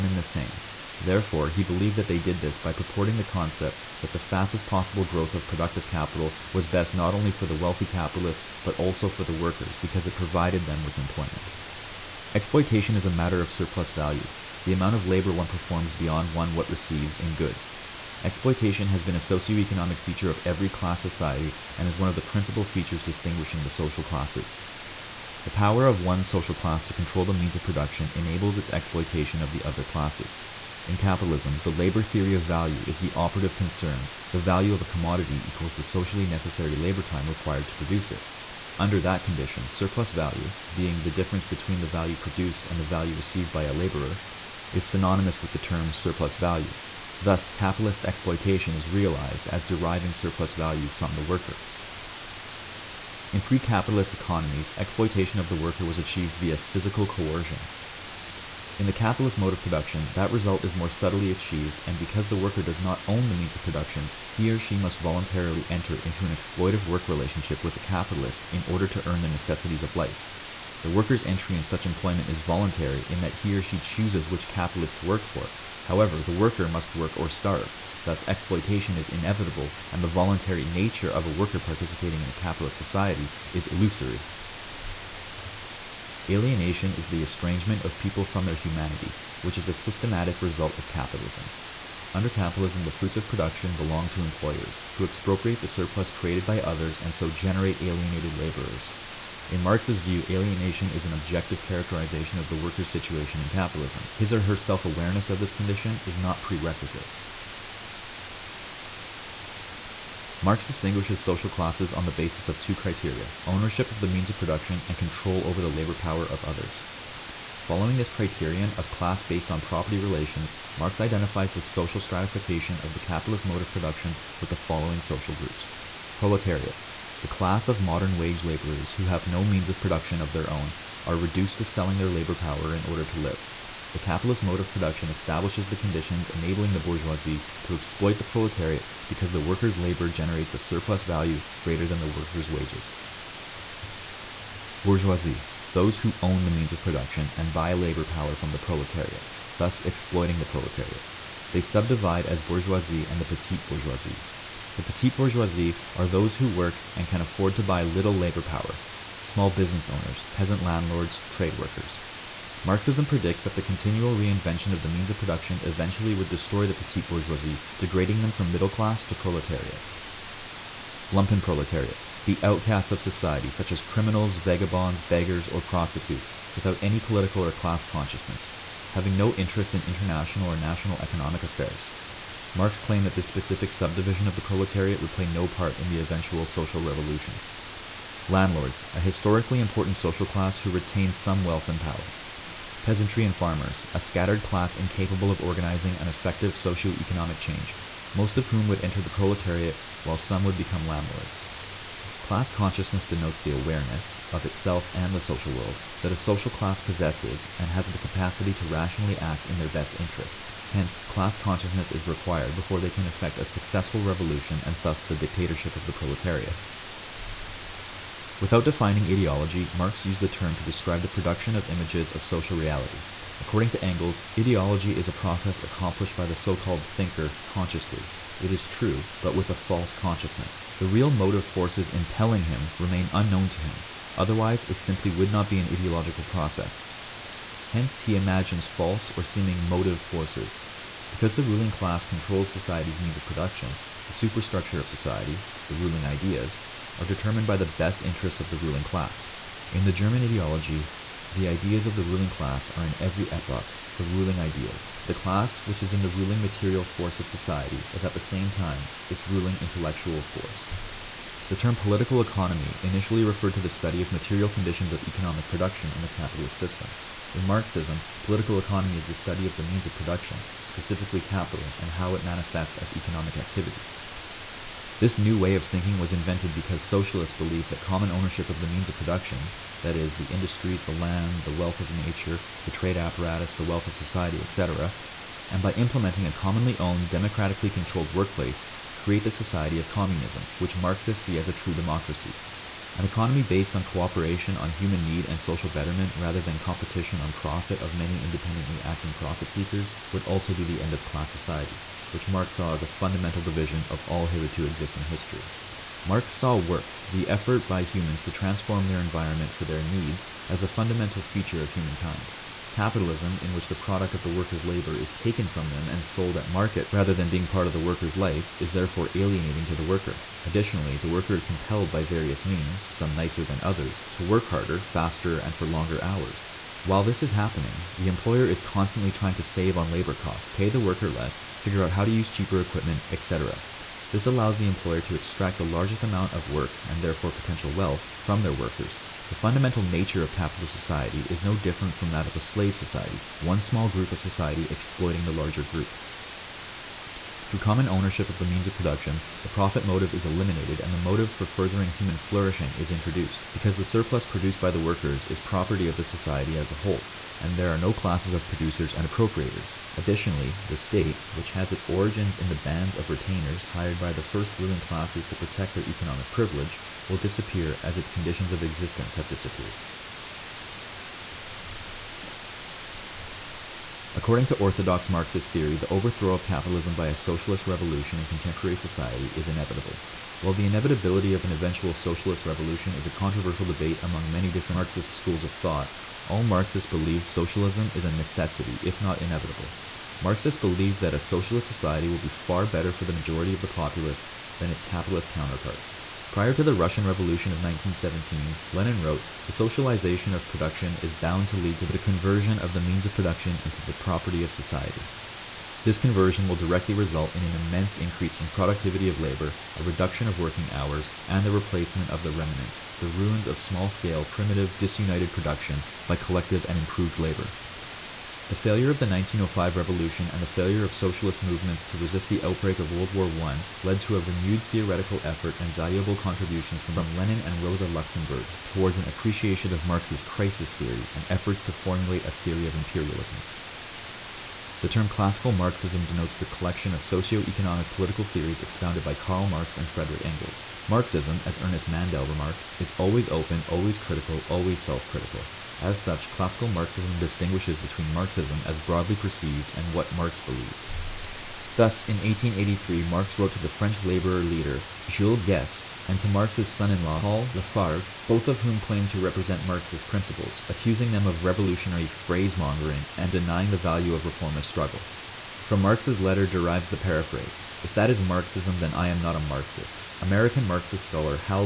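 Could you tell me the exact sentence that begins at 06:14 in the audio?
According to orthodox Marxist theory, the overthrow of capitalism by a socialist revolution in contemporary society is inevitable.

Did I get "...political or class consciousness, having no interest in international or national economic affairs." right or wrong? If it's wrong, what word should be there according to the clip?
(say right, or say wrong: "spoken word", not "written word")
right.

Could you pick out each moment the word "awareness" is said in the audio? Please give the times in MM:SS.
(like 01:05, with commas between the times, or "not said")
01:44, 03:23.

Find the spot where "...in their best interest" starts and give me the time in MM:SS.
03:29.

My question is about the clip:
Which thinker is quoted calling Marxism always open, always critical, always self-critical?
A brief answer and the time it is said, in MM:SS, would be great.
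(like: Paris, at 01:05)
Ernest Mandel, at 07:21.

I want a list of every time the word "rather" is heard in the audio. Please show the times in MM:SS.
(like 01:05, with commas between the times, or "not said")
04:56, 05:16.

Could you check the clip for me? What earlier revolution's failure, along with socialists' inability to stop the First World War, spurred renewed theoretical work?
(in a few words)
1905 revolution.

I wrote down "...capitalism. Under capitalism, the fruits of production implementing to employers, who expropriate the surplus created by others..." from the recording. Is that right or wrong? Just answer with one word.
wrong.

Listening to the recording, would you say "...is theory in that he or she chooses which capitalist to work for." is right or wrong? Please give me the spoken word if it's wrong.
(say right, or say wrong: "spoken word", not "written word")
wrong: "voluntary", not "theory".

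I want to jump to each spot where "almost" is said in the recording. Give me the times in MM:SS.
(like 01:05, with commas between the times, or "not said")
not said.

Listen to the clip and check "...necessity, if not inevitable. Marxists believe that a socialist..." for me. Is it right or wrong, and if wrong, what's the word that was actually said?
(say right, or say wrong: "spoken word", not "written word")
right.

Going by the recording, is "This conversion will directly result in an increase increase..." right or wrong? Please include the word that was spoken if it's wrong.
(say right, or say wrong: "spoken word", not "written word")
wrong: "immense", not "increase".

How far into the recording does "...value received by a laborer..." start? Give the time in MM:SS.
00:42.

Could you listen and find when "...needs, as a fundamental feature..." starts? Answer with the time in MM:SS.
05:09.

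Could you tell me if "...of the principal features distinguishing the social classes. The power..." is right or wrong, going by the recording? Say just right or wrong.
right.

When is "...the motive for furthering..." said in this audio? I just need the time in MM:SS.
05:50.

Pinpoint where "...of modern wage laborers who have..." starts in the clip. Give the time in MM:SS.
02:07.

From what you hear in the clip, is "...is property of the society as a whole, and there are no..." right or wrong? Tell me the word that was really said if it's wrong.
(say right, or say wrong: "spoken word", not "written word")
right.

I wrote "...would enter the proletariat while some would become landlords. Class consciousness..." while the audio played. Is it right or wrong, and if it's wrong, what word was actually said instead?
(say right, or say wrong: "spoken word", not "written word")
right.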